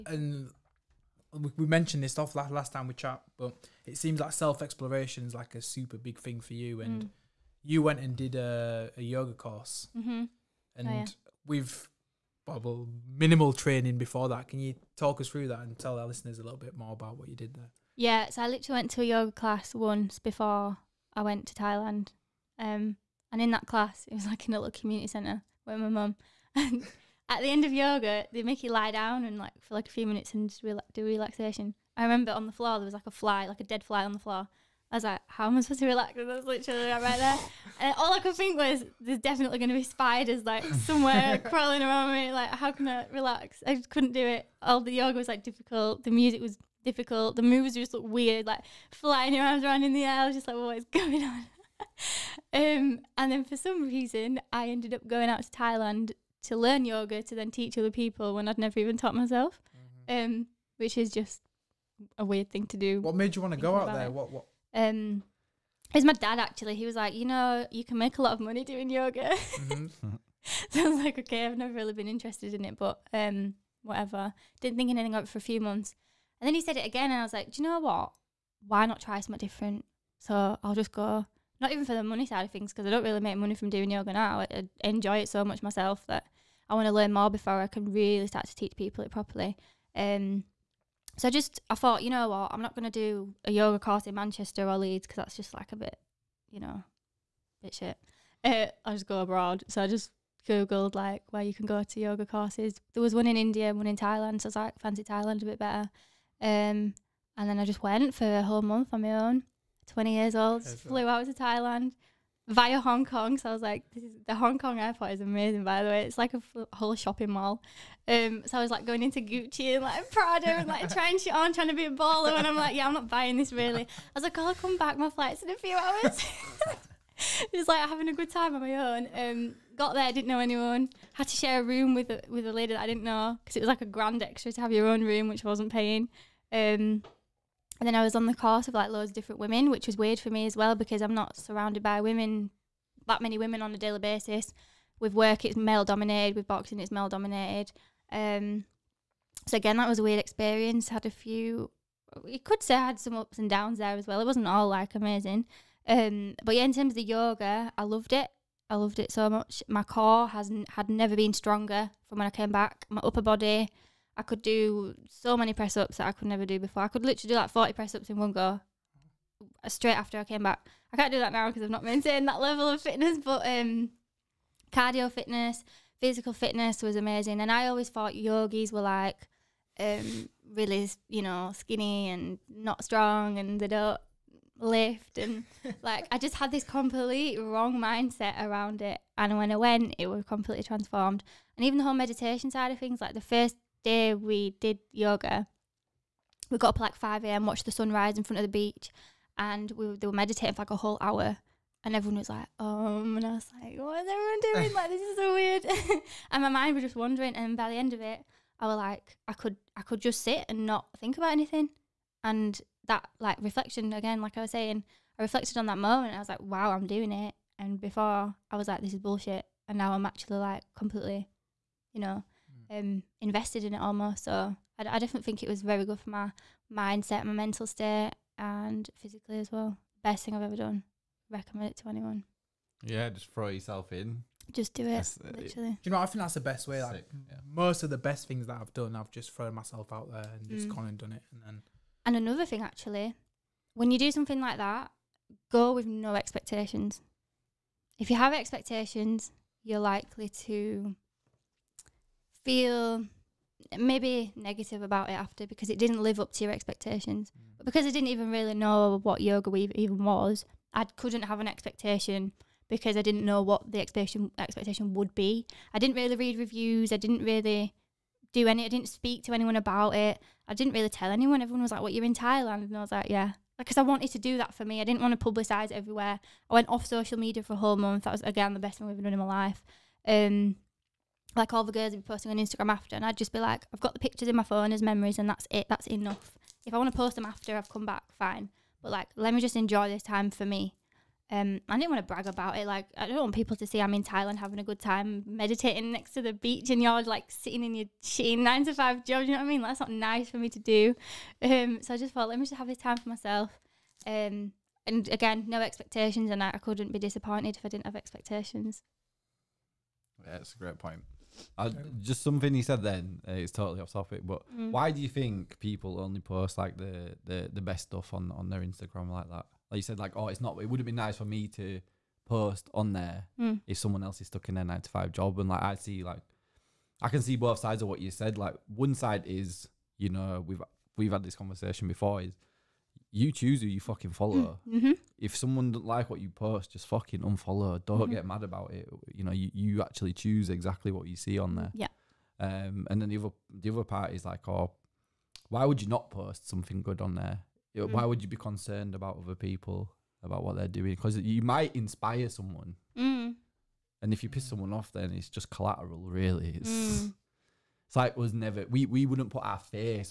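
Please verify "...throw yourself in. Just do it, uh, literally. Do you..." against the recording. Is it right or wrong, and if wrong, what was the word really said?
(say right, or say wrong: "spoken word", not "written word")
right.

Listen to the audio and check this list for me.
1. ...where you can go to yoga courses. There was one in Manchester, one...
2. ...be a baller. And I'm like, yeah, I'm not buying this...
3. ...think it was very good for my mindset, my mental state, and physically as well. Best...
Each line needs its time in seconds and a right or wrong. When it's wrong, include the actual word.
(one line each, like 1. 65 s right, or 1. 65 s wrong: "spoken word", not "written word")
1. 101 s wrong: "India", not "Manchester"
2. 121 s right
3. 225 s right.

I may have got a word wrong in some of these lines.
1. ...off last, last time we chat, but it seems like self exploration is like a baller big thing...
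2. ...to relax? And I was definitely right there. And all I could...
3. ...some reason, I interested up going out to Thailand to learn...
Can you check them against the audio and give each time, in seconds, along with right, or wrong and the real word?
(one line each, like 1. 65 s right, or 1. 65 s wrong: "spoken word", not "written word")
1. 2 s wrong: "super", not "baller"
2. 35 s wrong: "literally", not "definitely"
3. 53 s wrong: "ended", not "interested".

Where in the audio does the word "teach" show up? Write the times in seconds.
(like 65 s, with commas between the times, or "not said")
57 s, 88 s.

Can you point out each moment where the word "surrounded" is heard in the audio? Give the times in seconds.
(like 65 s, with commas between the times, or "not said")
141 s.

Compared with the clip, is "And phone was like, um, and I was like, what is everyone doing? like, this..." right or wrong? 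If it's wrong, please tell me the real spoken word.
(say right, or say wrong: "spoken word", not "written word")
wrong: "everyone", not "phone".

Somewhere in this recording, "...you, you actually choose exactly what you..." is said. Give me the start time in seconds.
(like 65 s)
339 s.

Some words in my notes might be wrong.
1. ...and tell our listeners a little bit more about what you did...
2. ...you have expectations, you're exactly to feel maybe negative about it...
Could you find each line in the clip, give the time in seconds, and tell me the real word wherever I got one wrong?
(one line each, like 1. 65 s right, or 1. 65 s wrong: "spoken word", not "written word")
1. 15 s right
2. 248 s wrong: "likely", not "exactly".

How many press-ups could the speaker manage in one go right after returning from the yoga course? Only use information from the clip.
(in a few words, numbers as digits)
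40.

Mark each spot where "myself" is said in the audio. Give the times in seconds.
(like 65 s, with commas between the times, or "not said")
59 s, 85 s, 239 s, 303 s.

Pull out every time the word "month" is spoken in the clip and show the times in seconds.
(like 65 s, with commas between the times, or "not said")
75 s, 108 s, 277 s.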